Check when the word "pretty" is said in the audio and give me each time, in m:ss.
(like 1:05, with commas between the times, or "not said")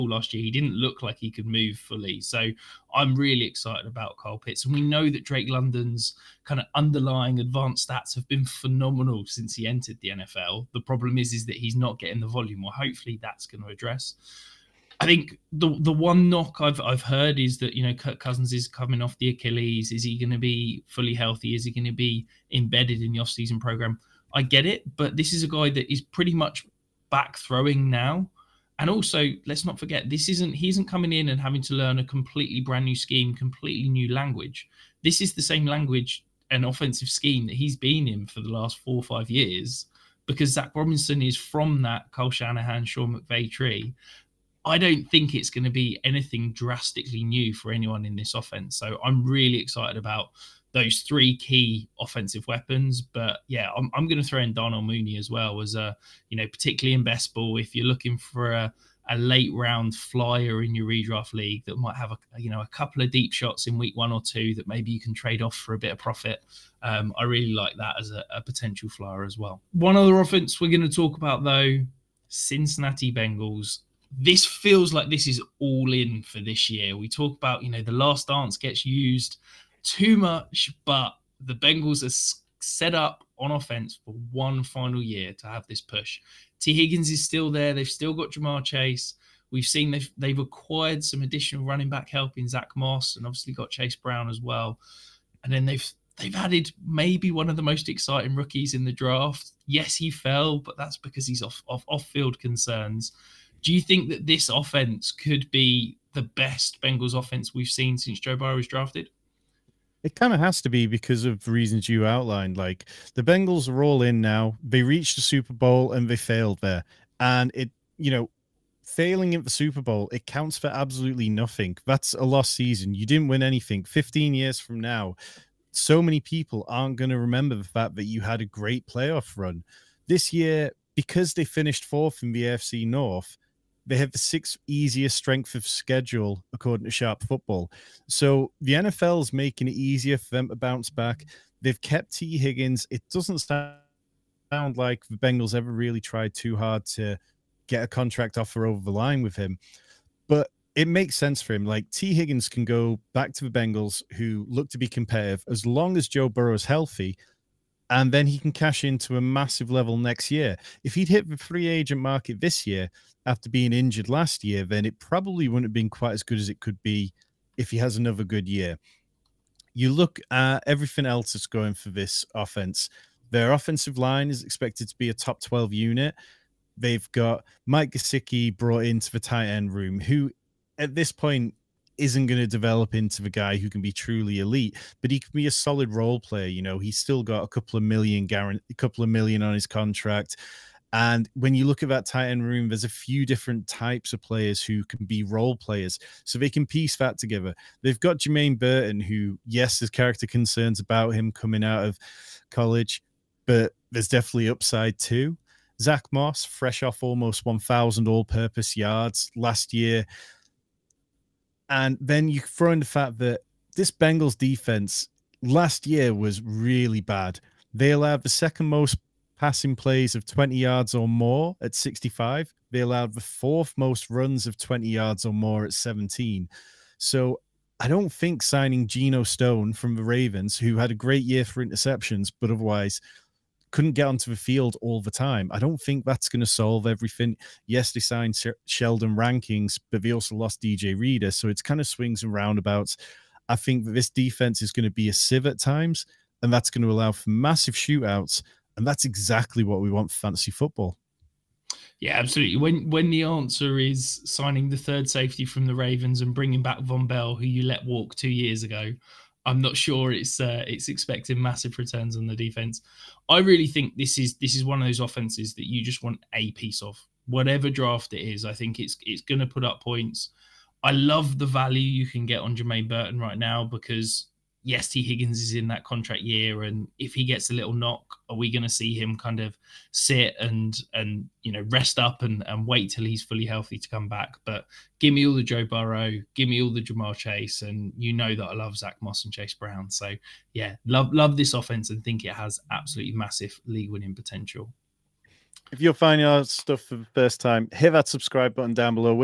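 0:26.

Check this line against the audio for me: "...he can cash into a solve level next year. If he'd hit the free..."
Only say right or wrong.
wrong.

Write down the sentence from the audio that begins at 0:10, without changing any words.
The problem is, is that he's not getting the volume.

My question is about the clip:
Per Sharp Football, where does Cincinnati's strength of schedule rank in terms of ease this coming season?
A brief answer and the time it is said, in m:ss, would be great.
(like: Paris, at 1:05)
6th easiest, at 2:14.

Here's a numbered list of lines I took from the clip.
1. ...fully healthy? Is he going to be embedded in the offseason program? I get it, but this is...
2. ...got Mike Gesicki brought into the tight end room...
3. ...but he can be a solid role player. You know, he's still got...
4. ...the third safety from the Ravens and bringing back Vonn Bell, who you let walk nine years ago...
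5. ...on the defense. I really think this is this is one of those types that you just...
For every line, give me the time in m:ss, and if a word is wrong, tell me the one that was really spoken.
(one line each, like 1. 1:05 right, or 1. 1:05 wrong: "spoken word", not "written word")
1. 0:20 right
2. 2:57 right
3. 3:04 right
4. 4:14 wrong: "two", not "nine"
5. 4:22 wrong: "offenses", not "types".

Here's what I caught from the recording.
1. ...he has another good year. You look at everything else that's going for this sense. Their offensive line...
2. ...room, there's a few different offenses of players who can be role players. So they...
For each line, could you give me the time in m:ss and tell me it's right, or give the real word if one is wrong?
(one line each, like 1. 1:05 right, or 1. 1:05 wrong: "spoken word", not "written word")
1. 2:47 wrong: "offense", not "sense"
2. 3:12 wrong: "types", not "offenses".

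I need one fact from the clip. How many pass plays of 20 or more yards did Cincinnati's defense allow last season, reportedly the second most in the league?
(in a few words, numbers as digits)
65.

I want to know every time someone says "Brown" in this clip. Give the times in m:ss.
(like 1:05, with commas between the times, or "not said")
1:33, 4:49.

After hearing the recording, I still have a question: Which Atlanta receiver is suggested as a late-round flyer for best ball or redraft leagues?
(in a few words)
Darnell Mooney.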